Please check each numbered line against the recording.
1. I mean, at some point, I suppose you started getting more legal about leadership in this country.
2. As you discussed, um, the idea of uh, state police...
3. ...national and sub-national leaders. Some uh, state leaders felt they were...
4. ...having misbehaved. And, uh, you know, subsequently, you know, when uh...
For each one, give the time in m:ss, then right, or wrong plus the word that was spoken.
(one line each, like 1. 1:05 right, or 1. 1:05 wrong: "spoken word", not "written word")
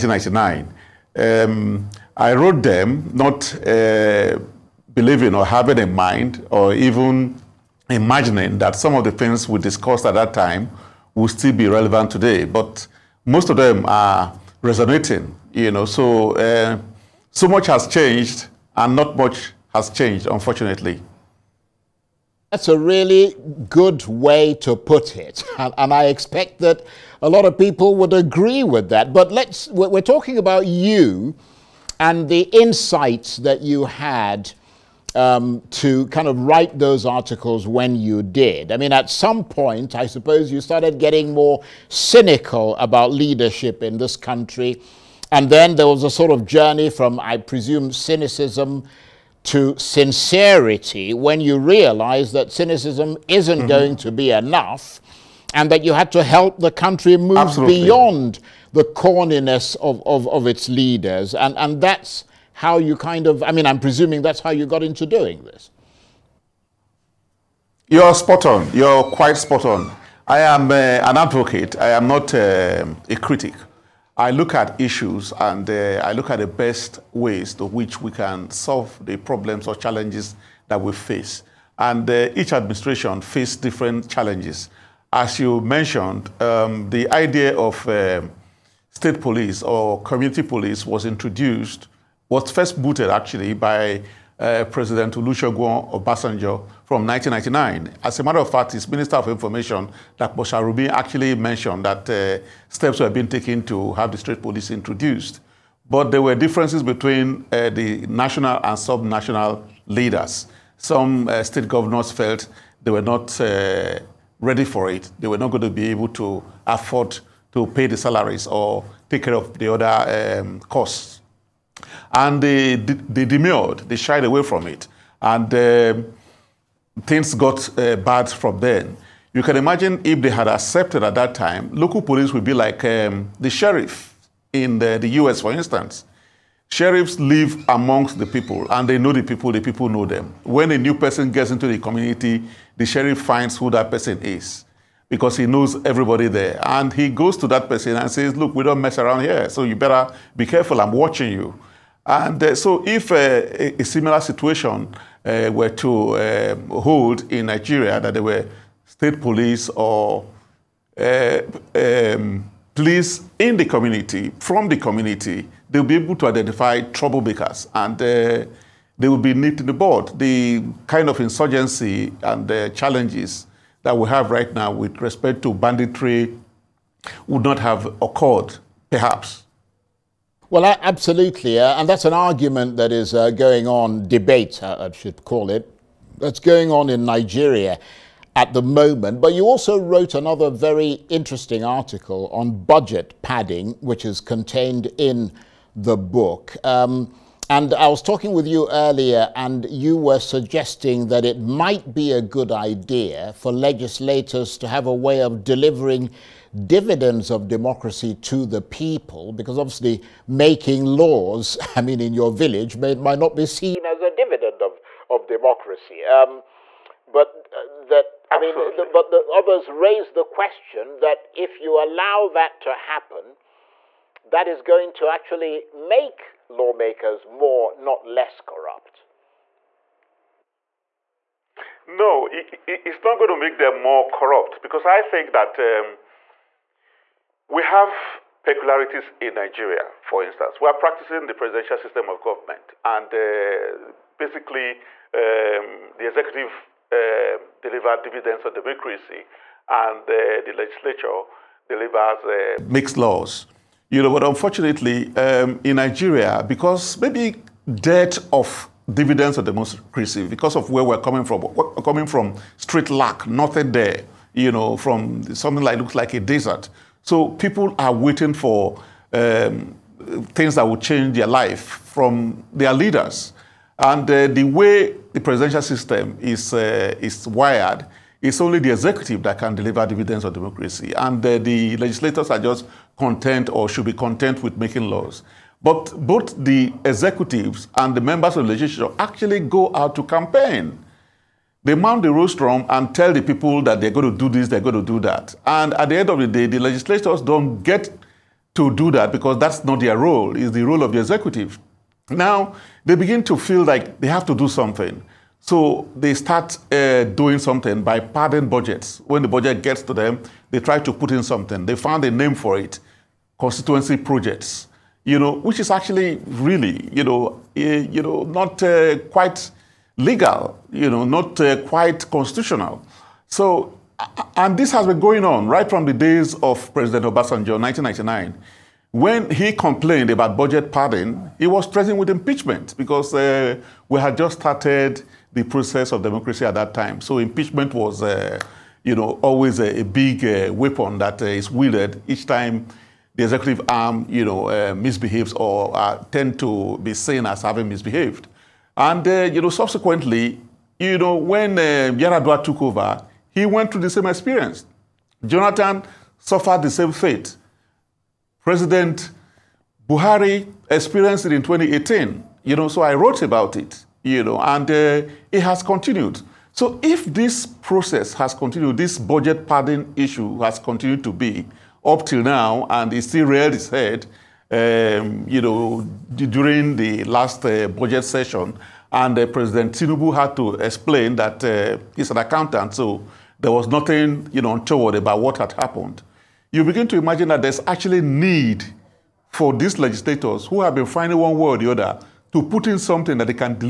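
1. 0:38 wrong: "cynical", not "legal"
2. 1:25 wrong: "mentioned", not "discussed"
3. 1:48 wrong: "governors", not "leaders"
4. 5:47 right.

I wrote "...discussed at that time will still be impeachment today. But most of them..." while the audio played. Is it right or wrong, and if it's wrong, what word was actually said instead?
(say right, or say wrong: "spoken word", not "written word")
wrong: "relevant", not "impeachment".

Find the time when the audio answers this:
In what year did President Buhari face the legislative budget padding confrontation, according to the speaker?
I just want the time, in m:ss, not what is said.
6:01.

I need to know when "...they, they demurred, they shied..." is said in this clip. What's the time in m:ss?
2:02.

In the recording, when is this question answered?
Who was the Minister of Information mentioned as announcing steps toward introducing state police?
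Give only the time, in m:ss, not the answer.
1:40.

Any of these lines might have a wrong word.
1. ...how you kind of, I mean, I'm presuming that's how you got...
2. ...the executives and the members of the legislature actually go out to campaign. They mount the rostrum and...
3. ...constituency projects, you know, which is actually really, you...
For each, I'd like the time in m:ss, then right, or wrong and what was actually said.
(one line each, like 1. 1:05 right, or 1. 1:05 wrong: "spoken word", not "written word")
1. 1:02 right
2. 4:46 right
3. 5:13 right.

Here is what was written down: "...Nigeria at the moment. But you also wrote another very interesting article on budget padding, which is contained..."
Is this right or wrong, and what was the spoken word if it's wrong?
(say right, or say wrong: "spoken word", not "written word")
right.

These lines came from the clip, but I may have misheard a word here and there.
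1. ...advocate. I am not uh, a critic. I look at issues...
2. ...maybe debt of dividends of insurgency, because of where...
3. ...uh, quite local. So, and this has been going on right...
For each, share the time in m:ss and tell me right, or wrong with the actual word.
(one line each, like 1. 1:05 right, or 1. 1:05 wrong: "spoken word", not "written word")
1. 1:11 right
2. 4:17 wrong: "democracy", not "insurgency"
3. 5:21 wrong: "constitutional", not "local".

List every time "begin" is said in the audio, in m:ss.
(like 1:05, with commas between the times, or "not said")
5:02, 6:26.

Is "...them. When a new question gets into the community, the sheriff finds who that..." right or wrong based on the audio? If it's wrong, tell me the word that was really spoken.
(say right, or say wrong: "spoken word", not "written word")
wrong: "person", not "question".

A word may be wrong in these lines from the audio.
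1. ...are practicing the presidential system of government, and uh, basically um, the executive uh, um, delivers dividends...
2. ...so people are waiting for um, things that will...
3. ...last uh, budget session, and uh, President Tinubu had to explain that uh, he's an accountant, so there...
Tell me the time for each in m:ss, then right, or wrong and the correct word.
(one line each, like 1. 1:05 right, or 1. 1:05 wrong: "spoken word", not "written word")
1. 4:00 right
2. 4:27 right
3. 6:17 right.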